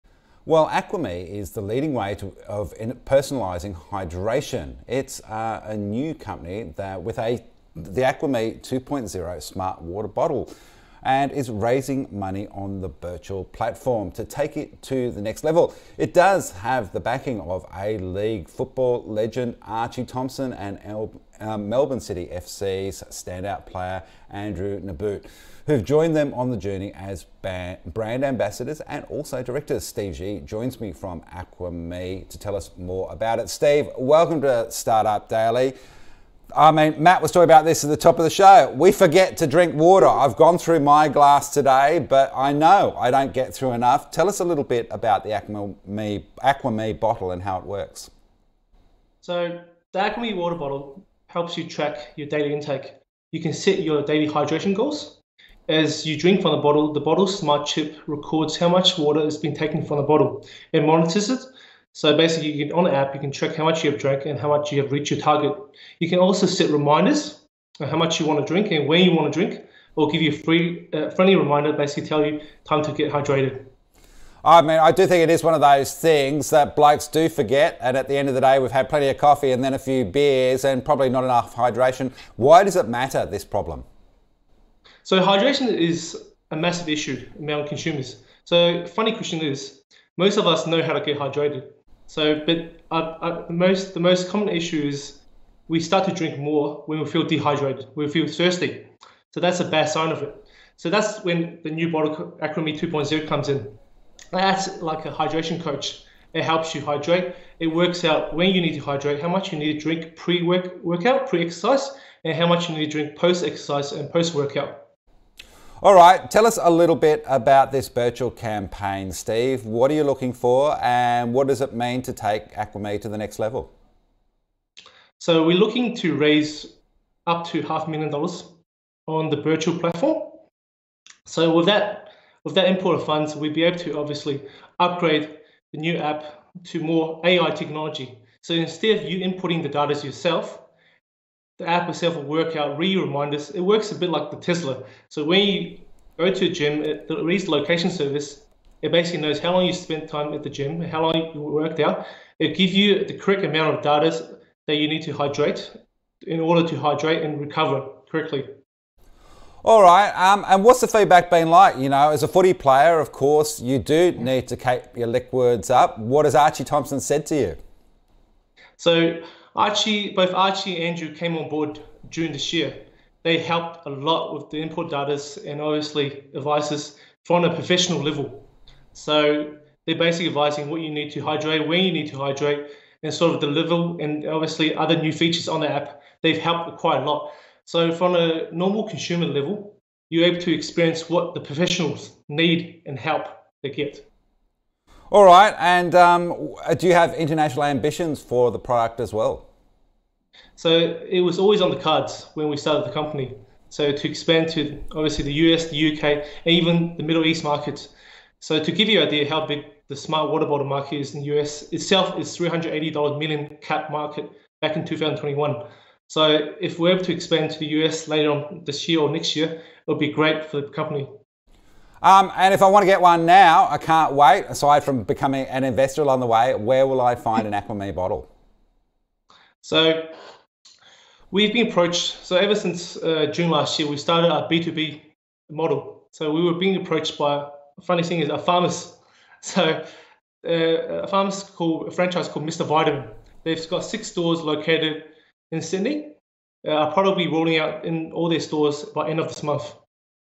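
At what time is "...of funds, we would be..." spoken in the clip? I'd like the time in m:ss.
2:12.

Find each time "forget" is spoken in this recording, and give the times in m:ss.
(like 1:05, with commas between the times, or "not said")
0:38, 1:17.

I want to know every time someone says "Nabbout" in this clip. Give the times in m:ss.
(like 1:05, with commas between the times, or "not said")
0:24.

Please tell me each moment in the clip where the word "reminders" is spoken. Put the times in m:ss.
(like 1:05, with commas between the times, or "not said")
1:06, 1:11, 2:22.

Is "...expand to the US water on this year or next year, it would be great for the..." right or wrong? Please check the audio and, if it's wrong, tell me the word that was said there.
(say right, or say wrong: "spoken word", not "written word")
wrong: "later", not "water".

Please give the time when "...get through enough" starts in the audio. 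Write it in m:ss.
0:43.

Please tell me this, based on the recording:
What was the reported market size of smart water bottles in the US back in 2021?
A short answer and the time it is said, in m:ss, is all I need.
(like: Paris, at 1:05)
$380 million, at 3:32.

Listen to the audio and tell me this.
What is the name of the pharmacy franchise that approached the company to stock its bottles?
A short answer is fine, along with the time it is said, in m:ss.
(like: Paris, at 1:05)
Mr. Vitamin, at 4:02.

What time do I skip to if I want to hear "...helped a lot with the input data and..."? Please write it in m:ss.
2:53.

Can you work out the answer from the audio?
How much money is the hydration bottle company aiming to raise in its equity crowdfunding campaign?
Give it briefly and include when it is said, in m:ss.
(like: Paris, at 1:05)
Up to half a million dollars, at 2:07.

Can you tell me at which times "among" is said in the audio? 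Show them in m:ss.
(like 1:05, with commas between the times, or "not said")
1:27.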